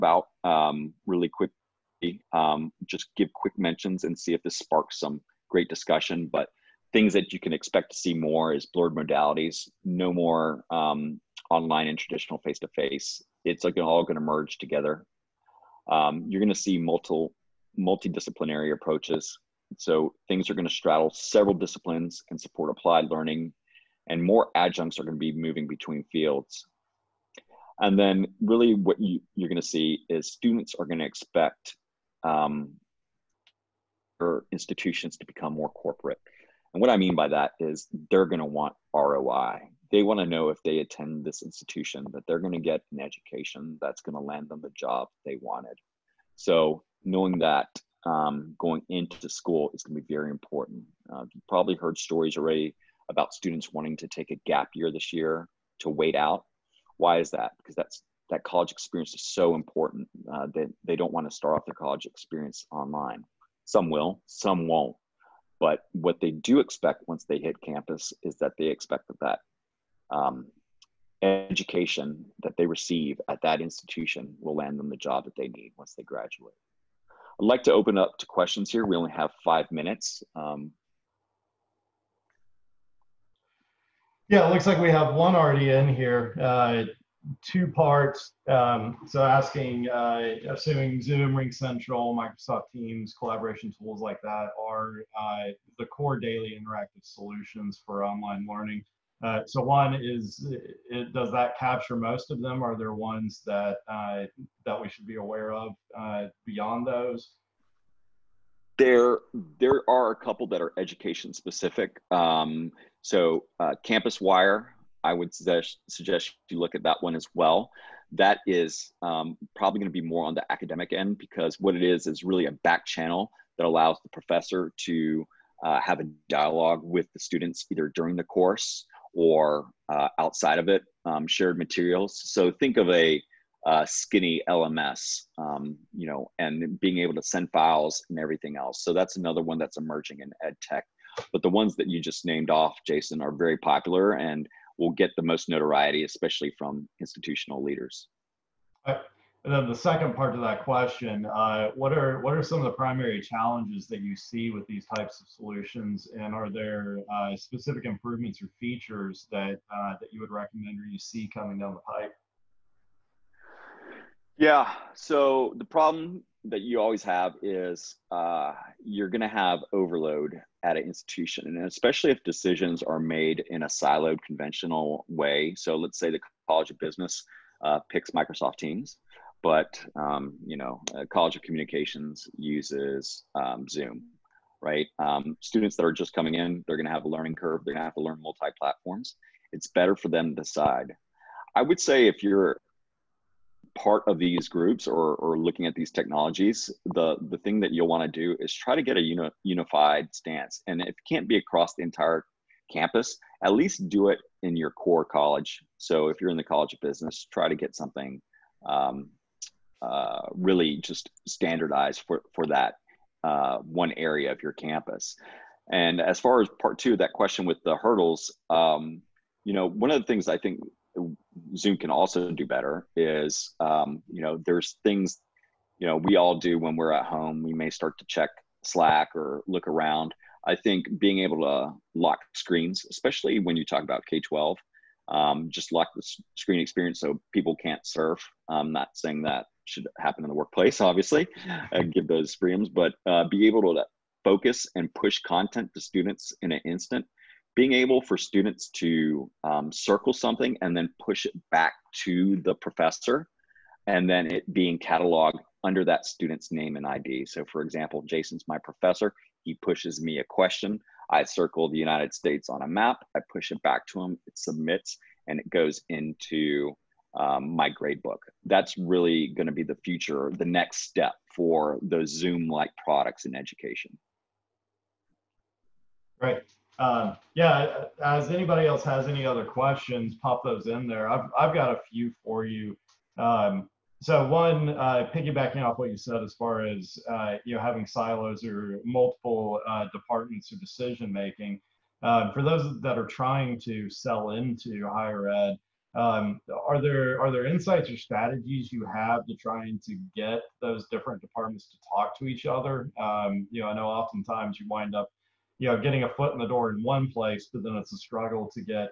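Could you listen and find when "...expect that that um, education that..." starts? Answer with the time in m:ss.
1:08.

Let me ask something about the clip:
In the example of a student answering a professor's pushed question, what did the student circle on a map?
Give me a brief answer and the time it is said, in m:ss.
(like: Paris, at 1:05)
the United States, at 4:21.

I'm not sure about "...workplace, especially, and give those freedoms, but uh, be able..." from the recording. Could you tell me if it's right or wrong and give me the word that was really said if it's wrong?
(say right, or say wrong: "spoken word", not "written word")
wrong: "obviously", not "especially".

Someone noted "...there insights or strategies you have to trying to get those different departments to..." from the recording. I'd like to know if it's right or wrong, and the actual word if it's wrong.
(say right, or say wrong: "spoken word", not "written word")
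right.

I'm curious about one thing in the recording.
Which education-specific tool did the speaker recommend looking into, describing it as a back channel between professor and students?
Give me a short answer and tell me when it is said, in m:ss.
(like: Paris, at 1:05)
Campuswire, at 1:53.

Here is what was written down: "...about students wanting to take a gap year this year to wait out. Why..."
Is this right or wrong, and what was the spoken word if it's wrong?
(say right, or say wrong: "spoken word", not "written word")
right.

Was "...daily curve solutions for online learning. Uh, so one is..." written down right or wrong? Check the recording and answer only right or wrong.
wrong.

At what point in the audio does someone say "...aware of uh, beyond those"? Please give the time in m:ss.
1:45.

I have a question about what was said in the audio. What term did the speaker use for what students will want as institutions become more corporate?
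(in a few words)
ROI.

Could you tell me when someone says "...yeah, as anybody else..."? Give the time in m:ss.
4:37.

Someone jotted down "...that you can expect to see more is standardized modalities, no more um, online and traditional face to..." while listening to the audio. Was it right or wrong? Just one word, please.
wrong.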